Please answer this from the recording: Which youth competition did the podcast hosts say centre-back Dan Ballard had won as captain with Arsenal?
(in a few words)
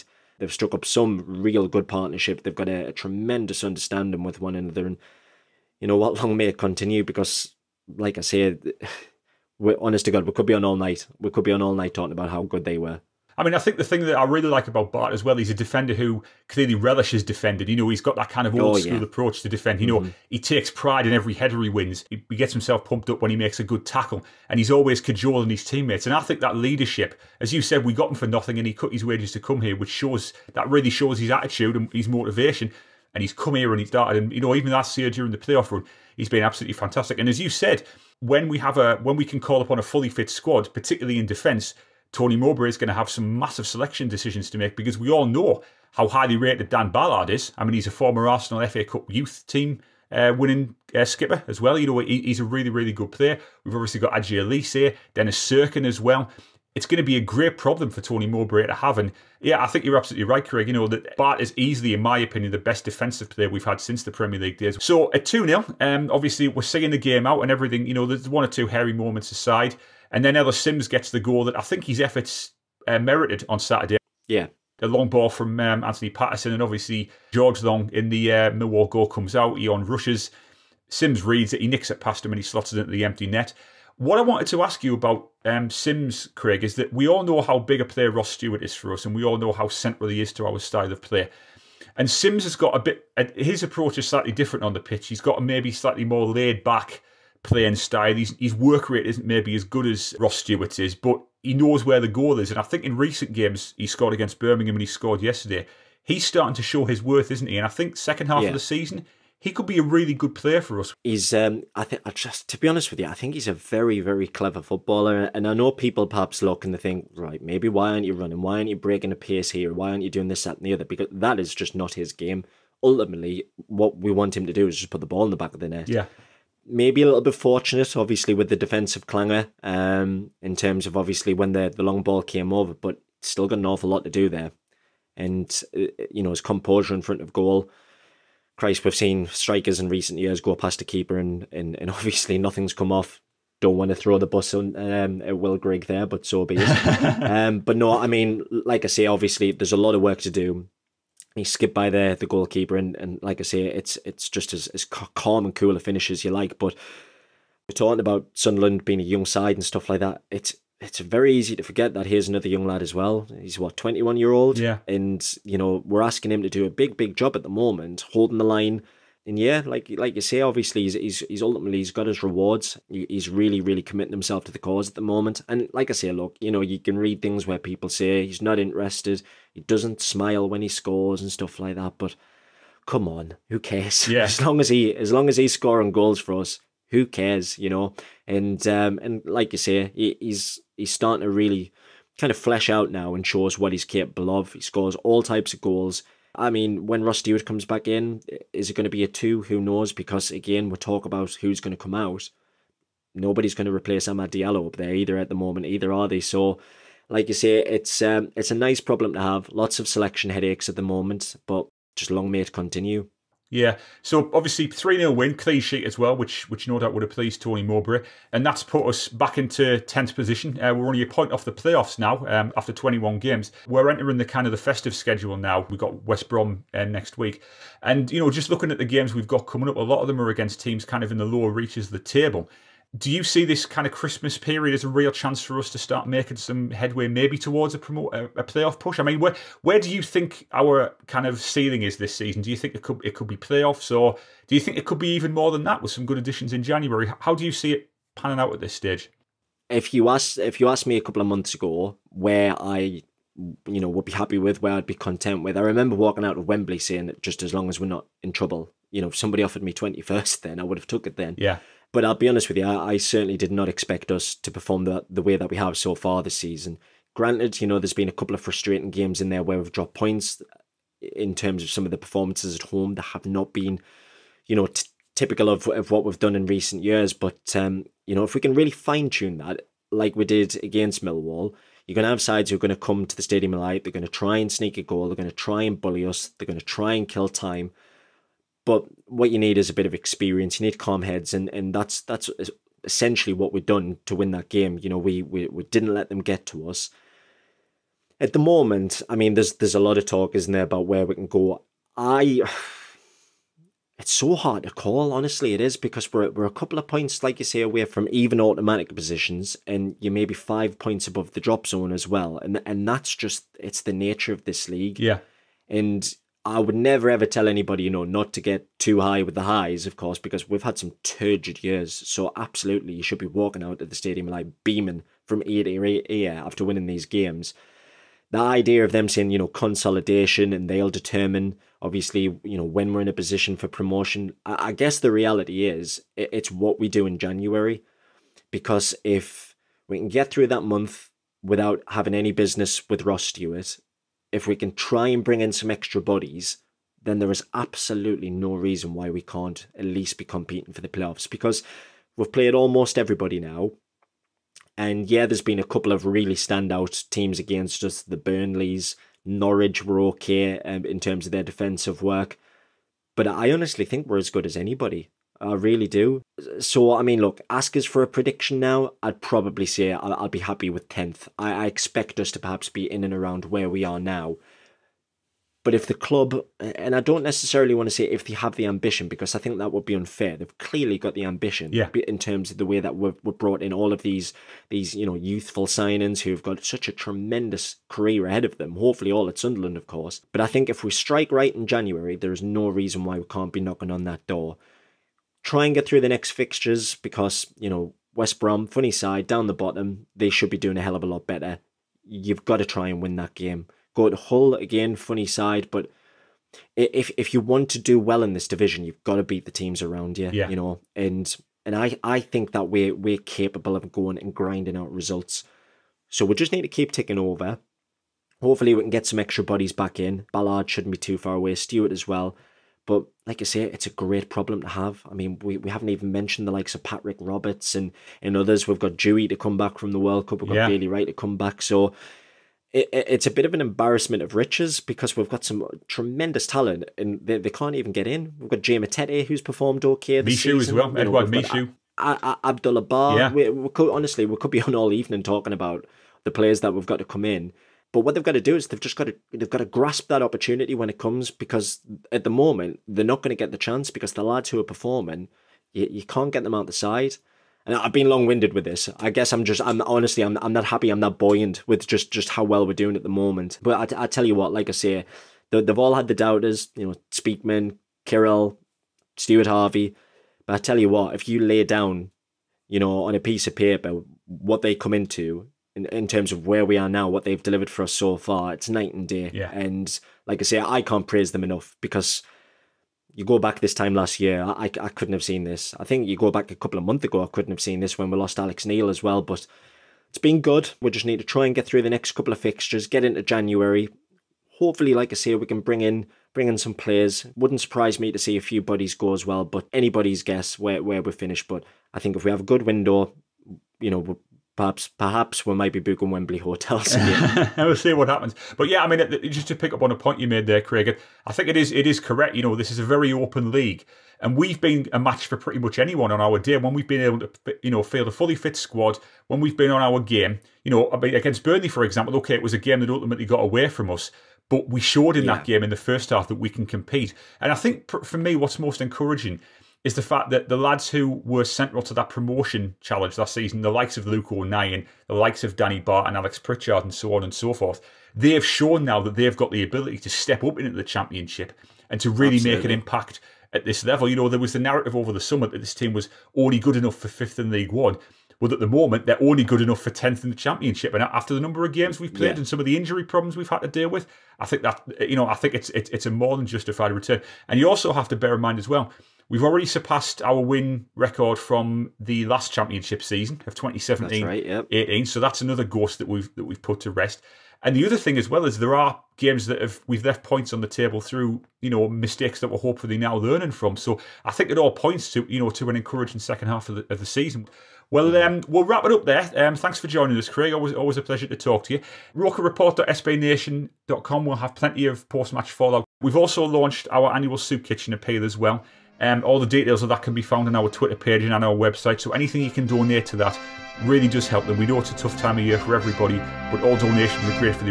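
FA Cup.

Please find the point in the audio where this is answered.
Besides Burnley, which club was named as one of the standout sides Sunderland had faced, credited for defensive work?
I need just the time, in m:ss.
5:59.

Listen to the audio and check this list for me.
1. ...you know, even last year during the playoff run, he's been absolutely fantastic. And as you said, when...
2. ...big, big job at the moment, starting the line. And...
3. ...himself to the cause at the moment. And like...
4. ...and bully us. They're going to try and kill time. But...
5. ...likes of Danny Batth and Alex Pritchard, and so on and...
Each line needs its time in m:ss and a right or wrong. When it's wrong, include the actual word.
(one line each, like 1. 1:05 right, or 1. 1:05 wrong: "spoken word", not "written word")
1. 0:34 right
2. 2:46 wrong: "holding", not "starting"
3. 2:54 right
4. 4:45 right
5. 8:55 right.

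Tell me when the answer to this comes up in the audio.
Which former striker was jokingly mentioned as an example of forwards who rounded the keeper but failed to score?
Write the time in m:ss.
2:25.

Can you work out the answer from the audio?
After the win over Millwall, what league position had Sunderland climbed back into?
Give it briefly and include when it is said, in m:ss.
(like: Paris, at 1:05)
10th, at 3:39.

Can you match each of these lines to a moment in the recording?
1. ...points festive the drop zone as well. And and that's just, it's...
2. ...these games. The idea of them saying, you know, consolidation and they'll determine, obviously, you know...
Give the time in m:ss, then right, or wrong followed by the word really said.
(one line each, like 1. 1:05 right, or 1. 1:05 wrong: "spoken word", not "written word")
1. 5:10 wrong: "above", not "festive"
2. 5:26 right.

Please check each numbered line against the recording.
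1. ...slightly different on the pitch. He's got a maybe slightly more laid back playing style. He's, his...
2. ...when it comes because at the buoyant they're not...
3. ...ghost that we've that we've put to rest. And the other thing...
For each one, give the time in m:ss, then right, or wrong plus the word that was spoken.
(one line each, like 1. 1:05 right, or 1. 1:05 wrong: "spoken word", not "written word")
1. 1:34 right
2. 7:30 wrong: "moment", not "buoyant"
3. 9:25 right.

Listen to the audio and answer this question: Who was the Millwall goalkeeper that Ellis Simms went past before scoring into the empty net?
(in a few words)
George Long.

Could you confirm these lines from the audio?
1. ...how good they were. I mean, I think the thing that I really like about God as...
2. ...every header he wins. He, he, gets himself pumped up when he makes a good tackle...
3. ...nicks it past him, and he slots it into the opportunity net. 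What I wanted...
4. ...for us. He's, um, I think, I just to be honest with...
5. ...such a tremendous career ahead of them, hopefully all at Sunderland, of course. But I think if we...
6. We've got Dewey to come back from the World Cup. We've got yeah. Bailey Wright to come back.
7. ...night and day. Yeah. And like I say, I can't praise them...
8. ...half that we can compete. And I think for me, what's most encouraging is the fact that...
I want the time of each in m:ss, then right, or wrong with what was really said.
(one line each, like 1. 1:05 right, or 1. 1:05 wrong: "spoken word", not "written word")
1. 0:12 wrong: "Batth", not "God"
2. 0:21 right
3. 1:21 wrong: "empty", not "opportunity"
4. 1:50 right
5. 6:26 right
6. 7:08 right
7. 7:58 right
8. 8:46 right.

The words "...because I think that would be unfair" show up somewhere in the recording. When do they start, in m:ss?
6:19.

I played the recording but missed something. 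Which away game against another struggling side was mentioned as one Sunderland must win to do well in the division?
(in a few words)
Hull.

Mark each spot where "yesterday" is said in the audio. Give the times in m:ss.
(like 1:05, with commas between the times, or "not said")
1:45.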